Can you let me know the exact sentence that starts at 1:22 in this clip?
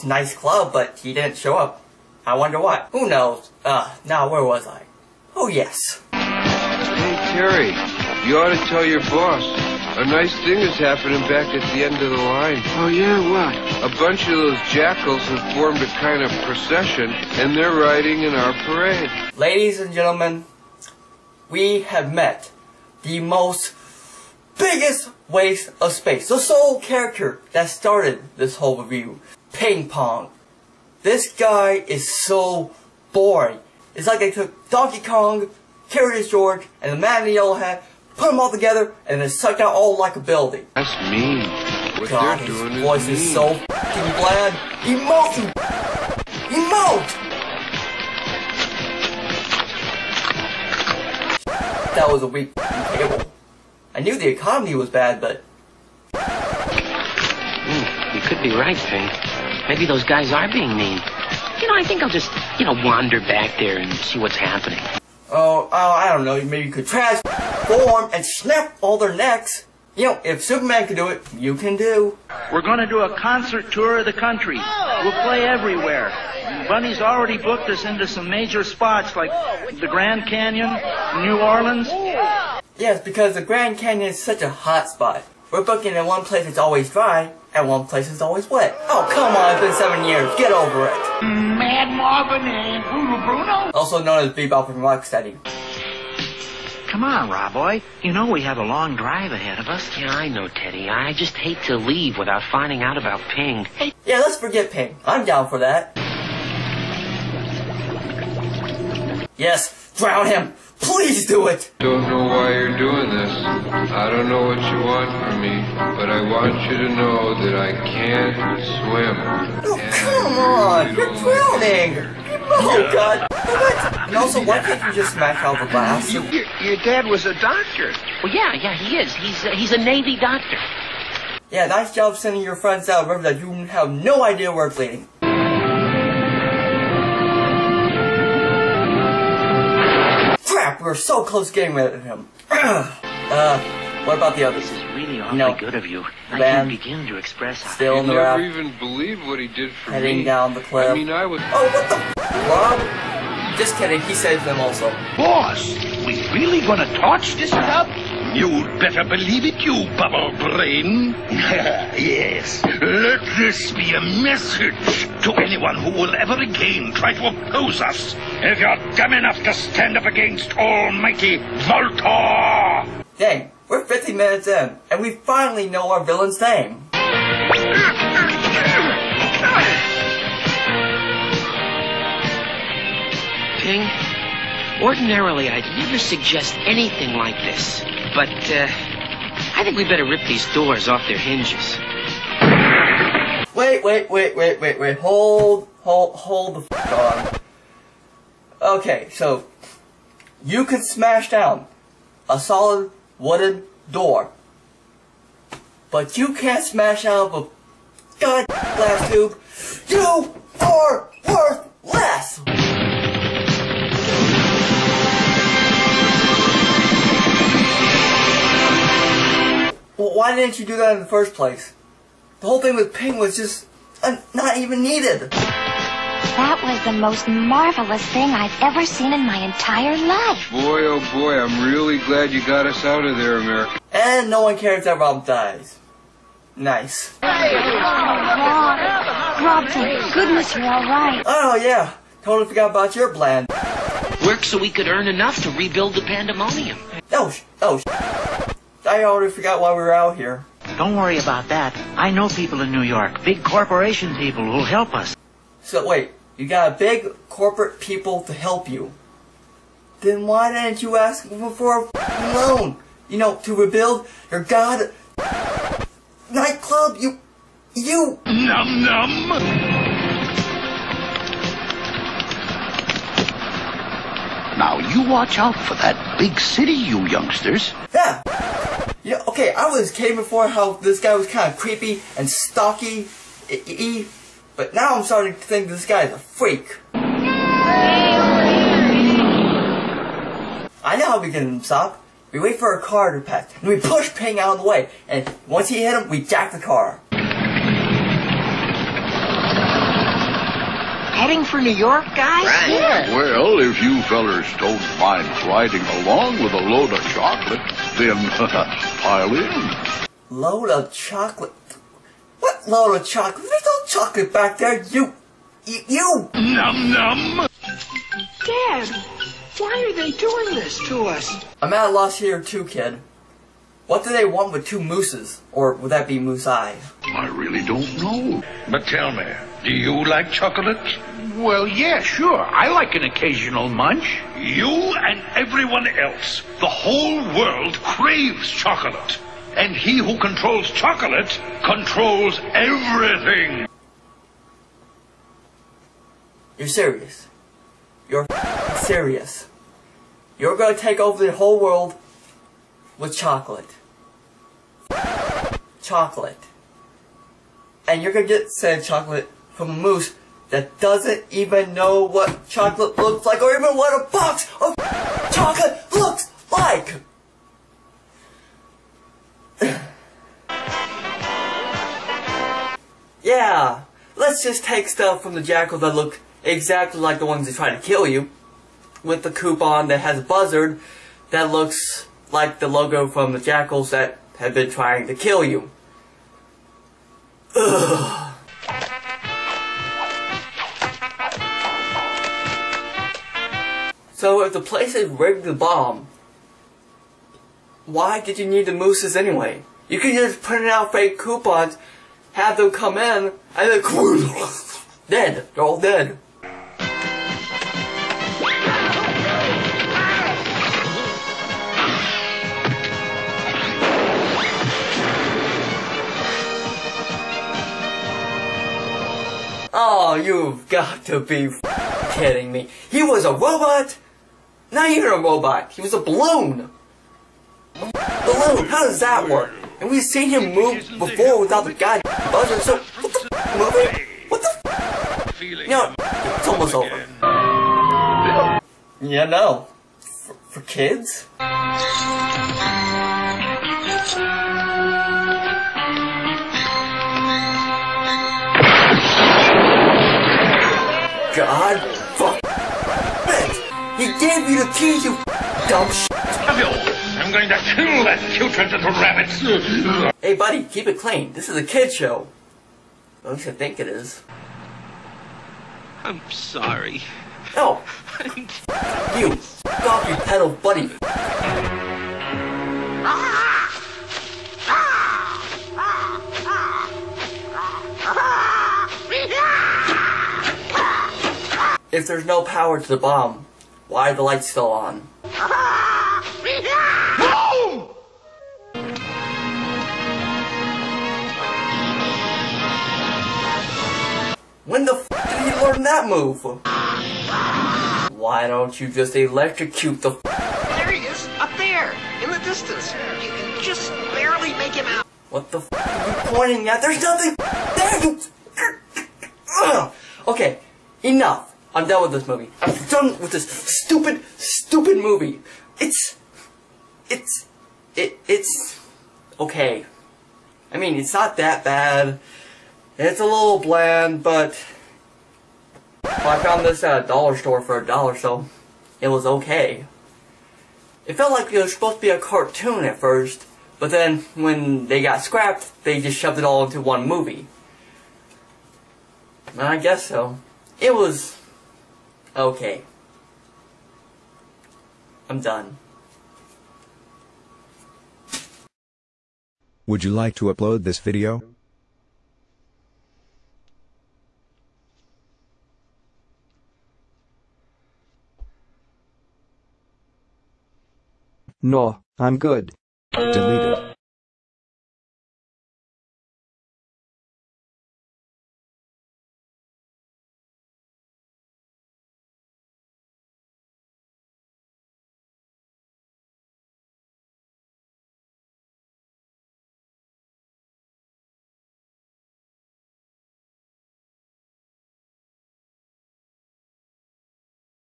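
Yes, because the Grand Canyon is such a hot spot.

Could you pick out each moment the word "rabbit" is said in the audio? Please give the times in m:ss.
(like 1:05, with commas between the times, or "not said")
7:38.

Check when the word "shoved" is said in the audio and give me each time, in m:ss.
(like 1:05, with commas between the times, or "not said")
8:56.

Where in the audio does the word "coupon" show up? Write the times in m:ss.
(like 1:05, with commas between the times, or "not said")
6:19, 6:41.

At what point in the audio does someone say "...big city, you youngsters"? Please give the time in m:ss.
4:36.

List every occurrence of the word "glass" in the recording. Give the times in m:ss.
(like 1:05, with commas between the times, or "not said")
2:05, 3:28.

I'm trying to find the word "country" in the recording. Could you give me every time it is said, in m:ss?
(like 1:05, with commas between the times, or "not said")
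1:14.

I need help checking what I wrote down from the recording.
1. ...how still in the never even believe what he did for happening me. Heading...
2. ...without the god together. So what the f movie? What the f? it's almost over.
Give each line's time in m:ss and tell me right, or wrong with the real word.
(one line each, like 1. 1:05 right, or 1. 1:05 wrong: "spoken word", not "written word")
1. 2:27 wrong: "heading", not "happening"
2. 7:11 wrong: "buzzer", not "together".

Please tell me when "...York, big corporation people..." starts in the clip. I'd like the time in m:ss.
4:12.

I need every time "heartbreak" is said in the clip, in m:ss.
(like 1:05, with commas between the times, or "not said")
not said.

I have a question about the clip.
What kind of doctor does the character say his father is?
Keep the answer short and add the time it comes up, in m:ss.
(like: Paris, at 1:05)
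Navy doctor, at 2:09.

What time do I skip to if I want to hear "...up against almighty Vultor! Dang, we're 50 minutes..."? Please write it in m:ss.
2:49.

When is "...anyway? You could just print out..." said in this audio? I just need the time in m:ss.
6:39.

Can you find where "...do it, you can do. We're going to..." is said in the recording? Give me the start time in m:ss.
1:10.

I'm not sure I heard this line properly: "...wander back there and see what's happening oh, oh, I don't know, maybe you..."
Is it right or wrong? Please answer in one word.
right.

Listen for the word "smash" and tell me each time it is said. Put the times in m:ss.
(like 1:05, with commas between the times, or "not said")
2:05, 3:20, 3:26.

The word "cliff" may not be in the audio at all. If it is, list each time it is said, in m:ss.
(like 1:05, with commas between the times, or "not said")
2:30.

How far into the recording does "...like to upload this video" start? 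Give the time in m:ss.
9:10.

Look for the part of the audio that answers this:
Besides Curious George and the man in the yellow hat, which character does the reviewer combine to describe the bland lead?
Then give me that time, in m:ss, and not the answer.
0:34.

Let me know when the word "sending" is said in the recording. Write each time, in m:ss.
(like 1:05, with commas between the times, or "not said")
2:12.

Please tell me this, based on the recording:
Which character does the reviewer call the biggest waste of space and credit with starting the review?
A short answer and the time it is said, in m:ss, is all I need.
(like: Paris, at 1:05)
Ping Pong, at 0:29.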